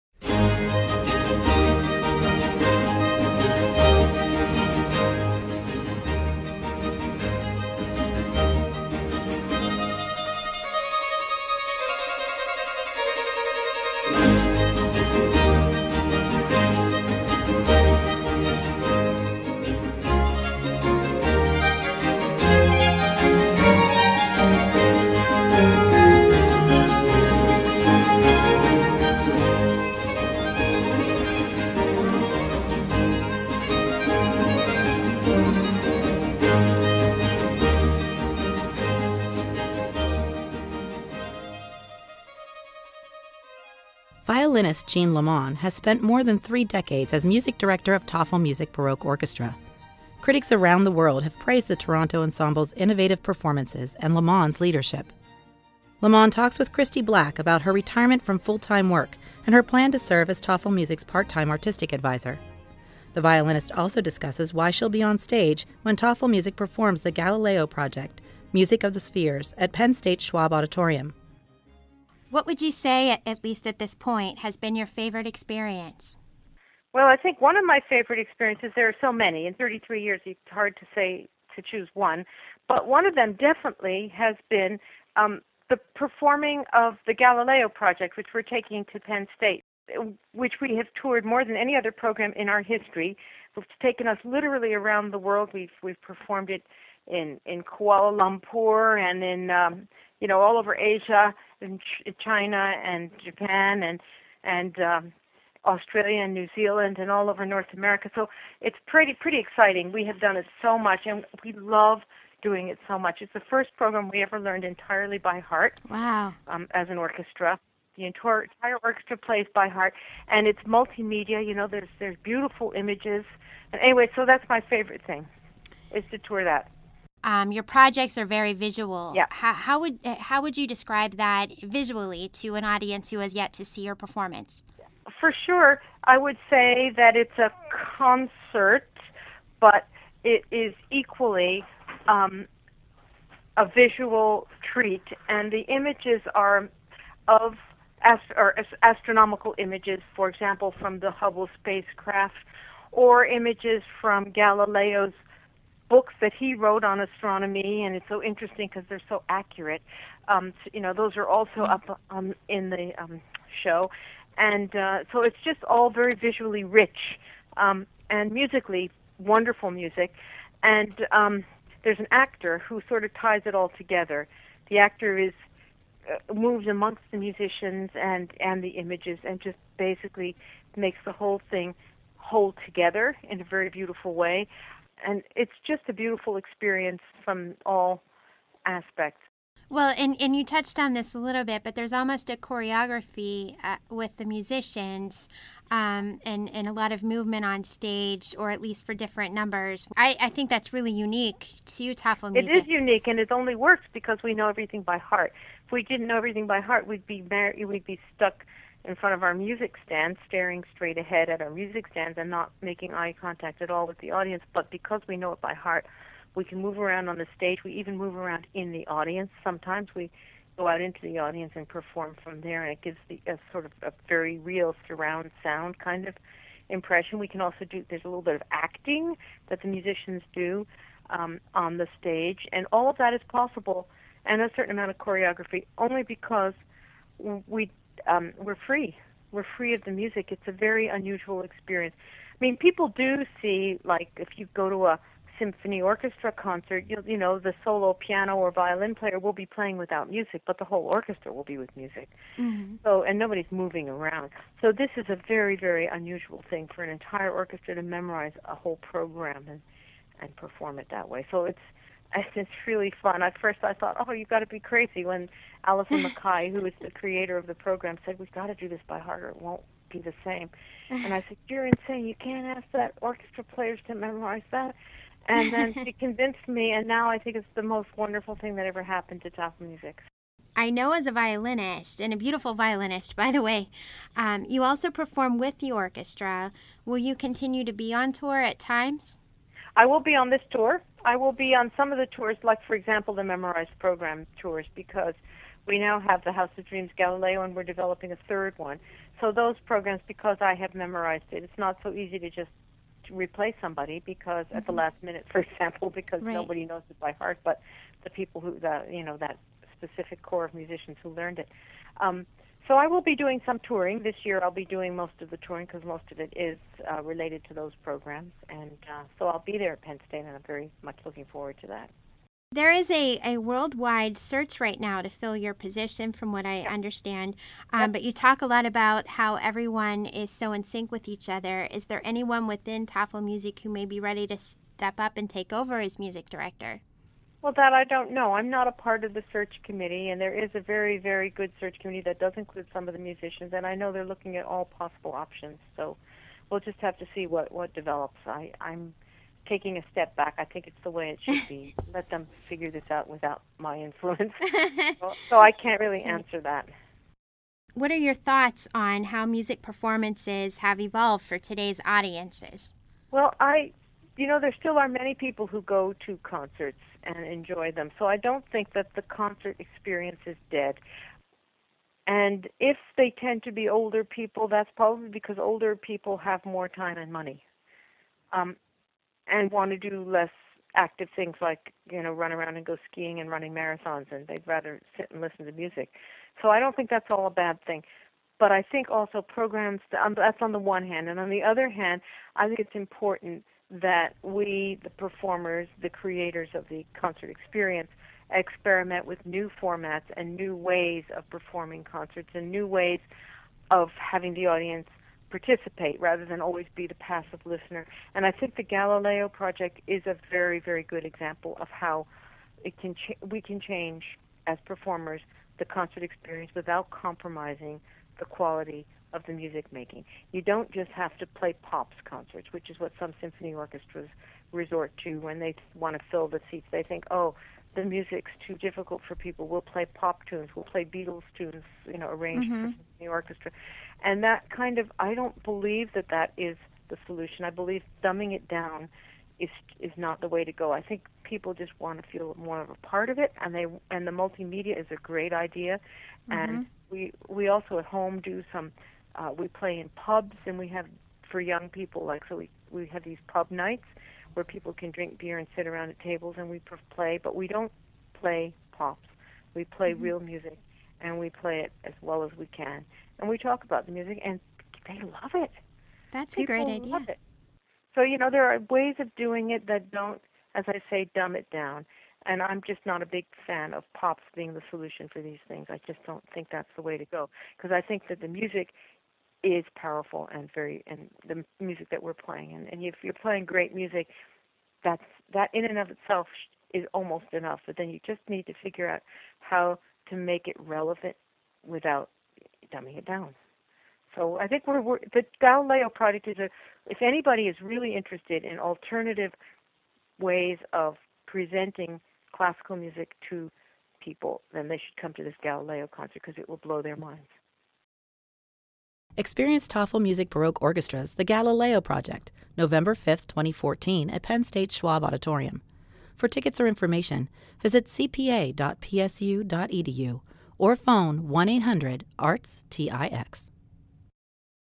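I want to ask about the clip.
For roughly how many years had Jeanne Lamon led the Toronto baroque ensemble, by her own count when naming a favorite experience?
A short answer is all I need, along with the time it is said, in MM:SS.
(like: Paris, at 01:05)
33, at 01:19.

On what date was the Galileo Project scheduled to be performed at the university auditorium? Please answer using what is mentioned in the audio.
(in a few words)
November 5, 2014.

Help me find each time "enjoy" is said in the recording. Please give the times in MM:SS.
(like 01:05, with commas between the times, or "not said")
06:07.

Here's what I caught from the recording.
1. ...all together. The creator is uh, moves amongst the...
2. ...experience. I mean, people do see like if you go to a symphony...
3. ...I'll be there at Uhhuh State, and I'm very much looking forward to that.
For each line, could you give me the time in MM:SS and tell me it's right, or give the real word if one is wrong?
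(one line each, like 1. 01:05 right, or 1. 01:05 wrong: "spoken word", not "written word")
1. 02:53 wrong: "actor", not "creator"
2. 04:01 right
3. 05:19 wrong: "Penn", not "Uhhuh".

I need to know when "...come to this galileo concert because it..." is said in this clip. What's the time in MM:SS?
08:25.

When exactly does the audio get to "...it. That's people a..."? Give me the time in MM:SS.
07:45.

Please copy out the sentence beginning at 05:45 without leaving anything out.
So we'll just have to see what, what develops.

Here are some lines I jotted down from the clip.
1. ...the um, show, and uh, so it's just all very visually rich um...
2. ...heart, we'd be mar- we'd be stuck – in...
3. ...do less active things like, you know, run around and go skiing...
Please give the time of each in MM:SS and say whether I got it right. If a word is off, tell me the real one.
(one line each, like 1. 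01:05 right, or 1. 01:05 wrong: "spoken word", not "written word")
1. 02:42 right
2. 03:26 right
3. 06:19 right.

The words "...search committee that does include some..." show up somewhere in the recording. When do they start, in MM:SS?
05:41.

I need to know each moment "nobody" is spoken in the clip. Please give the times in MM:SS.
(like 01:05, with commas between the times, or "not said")
04:13, 05:06.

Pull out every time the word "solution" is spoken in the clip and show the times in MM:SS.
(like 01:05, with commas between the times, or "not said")
07:17, 07:54.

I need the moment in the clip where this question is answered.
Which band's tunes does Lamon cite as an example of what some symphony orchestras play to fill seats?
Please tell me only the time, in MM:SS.
07:10.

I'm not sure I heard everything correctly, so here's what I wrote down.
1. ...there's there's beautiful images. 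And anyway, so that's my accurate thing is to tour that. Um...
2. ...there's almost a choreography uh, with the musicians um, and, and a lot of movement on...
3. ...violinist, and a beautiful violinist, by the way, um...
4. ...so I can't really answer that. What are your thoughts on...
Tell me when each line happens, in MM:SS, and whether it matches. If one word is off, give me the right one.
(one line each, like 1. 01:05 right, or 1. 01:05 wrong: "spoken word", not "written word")
1. 02:01 wrong: "favorite", not "accurate"
2. 03:11 right
3. 04:41 right
4. 05:55 right.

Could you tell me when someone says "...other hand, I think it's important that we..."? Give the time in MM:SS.
06:31.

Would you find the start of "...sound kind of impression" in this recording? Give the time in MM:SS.
03:45.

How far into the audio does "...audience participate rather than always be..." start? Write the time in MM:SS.
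06:44.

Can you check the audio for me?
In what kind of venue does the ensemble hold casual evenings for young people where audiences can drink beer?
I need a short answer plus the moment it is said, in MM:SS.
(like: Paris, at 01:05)
Pubs, at 07:29.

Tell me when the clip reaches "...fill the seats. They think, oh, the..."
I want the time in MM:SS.
07:06.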